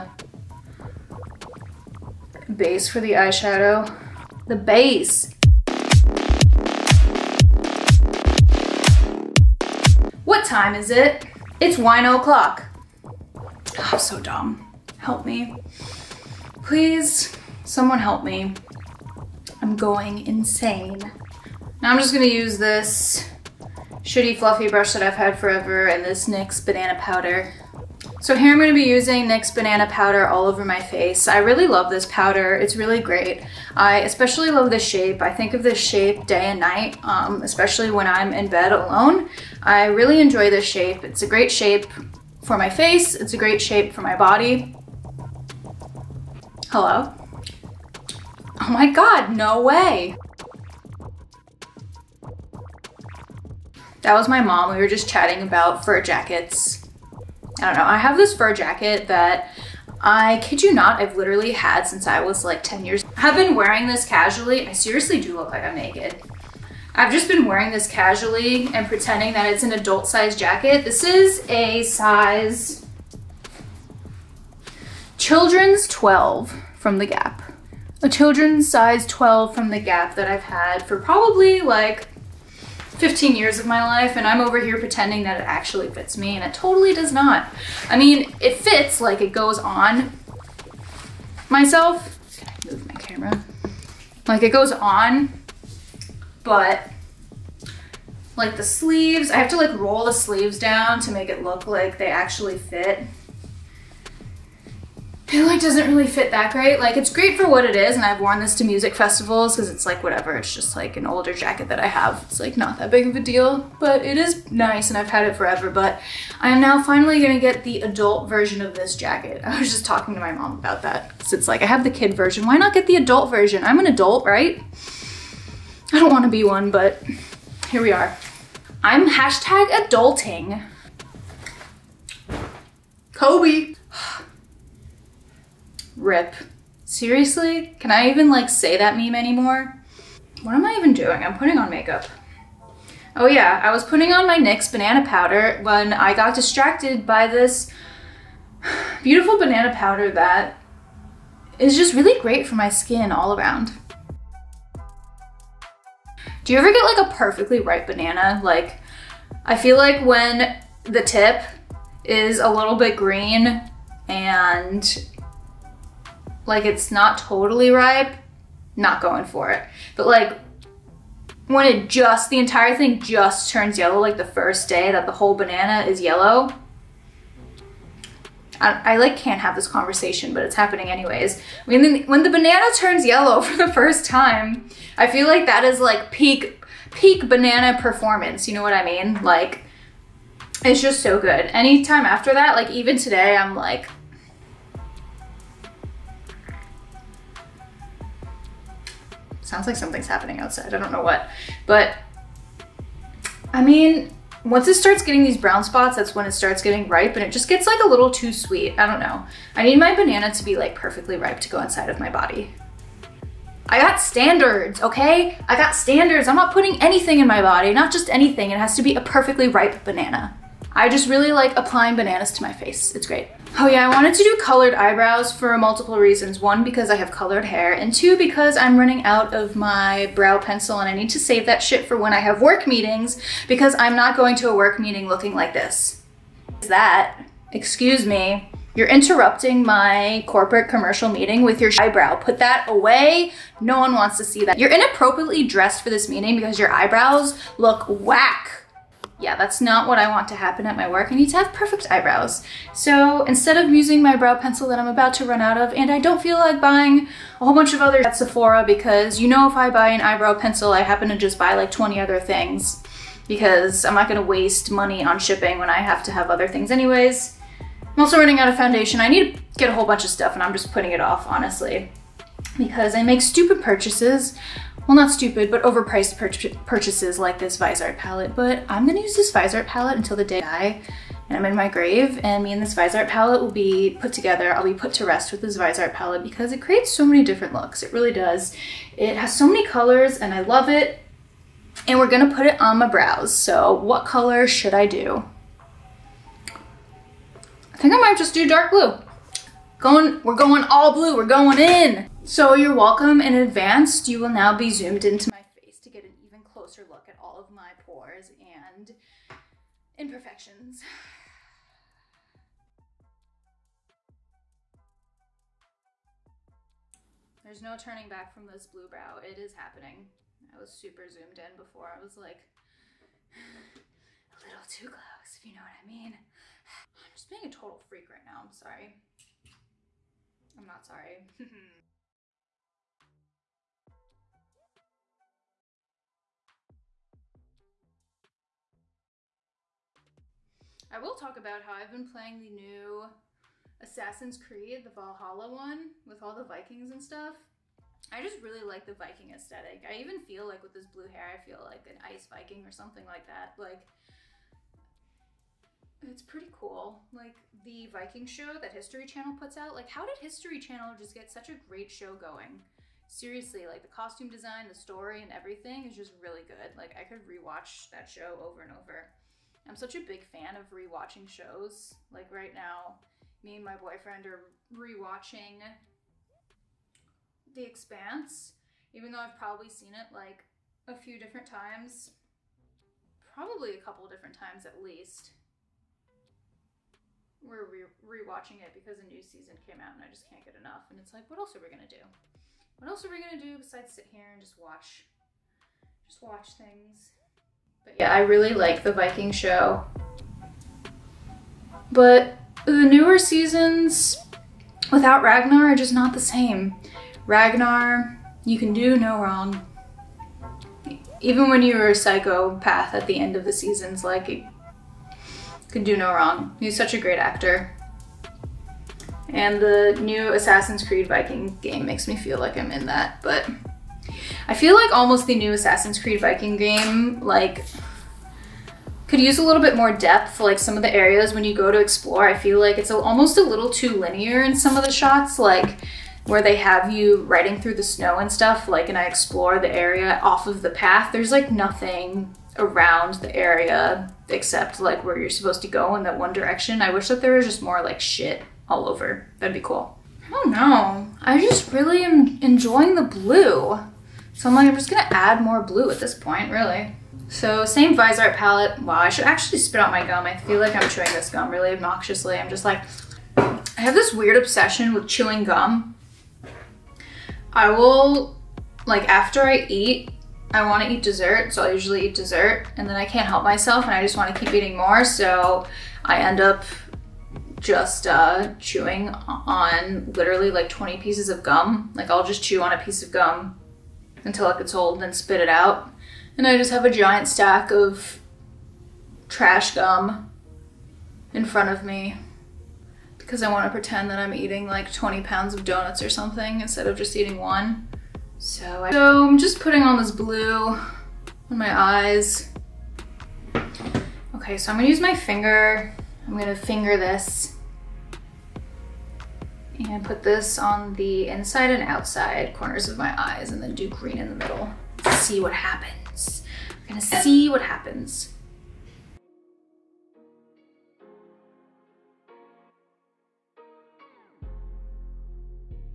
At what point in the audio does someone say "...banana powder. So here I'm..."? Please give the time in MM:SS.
00:26.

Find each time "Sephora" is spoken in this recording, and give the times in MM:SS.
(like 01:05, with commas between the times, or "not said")
04:18.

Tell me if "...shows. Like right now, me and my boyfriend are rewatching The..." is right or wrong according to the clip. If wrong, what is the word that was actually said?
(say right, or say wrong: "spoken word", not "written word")
right.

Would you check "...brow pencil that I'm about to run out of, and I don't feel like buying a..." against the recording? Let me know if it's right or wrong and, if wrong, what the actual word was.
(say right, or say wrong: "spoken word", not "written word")
right.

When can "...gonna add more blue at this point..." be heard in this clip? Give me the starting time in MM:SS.
07:34.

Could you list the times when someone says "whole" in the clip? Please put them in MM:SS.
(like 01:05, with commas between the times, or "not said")
02:55, 04:17, 04:29.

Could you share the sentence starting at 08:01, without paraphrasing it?
Like I'll just chew on a piece of gum until it gets old and spit it out.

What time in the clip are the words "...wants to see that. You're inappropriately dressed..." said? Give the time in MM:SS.
04:03.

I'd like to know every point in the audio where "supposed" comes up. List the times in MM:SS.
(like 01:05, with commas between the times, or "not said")
07:25.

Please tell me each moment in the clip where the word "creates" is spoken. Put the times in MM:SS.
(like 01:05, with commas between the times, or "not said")
04:46.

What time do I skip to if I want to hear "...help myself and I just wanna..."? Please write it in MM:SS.
07:53.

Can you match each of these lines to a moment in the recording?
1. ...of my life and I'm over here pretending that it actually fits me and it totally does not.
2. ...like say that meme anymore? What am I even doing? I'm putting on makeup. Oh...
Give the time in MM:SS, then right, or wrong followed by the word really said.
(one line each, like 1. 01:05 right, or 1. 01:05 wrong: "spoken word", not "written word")
1. 01:23 right
2. 02:18 right.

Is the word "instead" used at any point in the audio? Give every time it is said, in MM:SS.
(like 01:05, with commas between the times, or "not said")
04:13, 08:16.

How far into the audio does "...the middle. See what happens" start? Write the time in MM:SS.
08:34.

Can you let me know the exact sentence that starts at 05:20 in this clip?
I was super zoomed in before.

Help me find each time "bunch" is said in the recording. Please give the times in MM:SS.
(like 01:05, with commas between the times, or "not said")
04:17, 04:29.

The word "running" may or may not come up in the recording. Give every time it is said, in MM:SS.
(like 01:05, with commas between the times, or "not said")
03:48, 04:28.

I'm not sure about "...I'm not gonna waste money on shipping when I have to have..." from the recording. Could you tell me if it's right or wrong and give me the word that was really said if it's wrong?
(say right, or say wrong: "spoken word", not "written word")
right.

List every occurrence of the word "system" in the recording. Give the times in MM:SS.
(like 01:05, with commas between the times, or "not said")
not said.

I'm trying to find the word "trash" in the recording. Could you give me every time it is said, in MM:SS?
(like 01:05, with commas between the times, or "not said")
08:09.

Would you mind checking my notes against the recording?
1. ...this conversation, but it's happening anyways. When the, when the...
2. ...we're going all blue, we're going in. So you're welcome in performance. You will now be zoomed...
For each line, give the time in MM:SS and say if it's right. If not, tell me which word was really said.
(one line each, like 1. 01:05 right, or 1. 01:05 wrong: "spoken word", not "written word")
1. 02:59 right
2. 05:00 wrong: "advance", not "performance".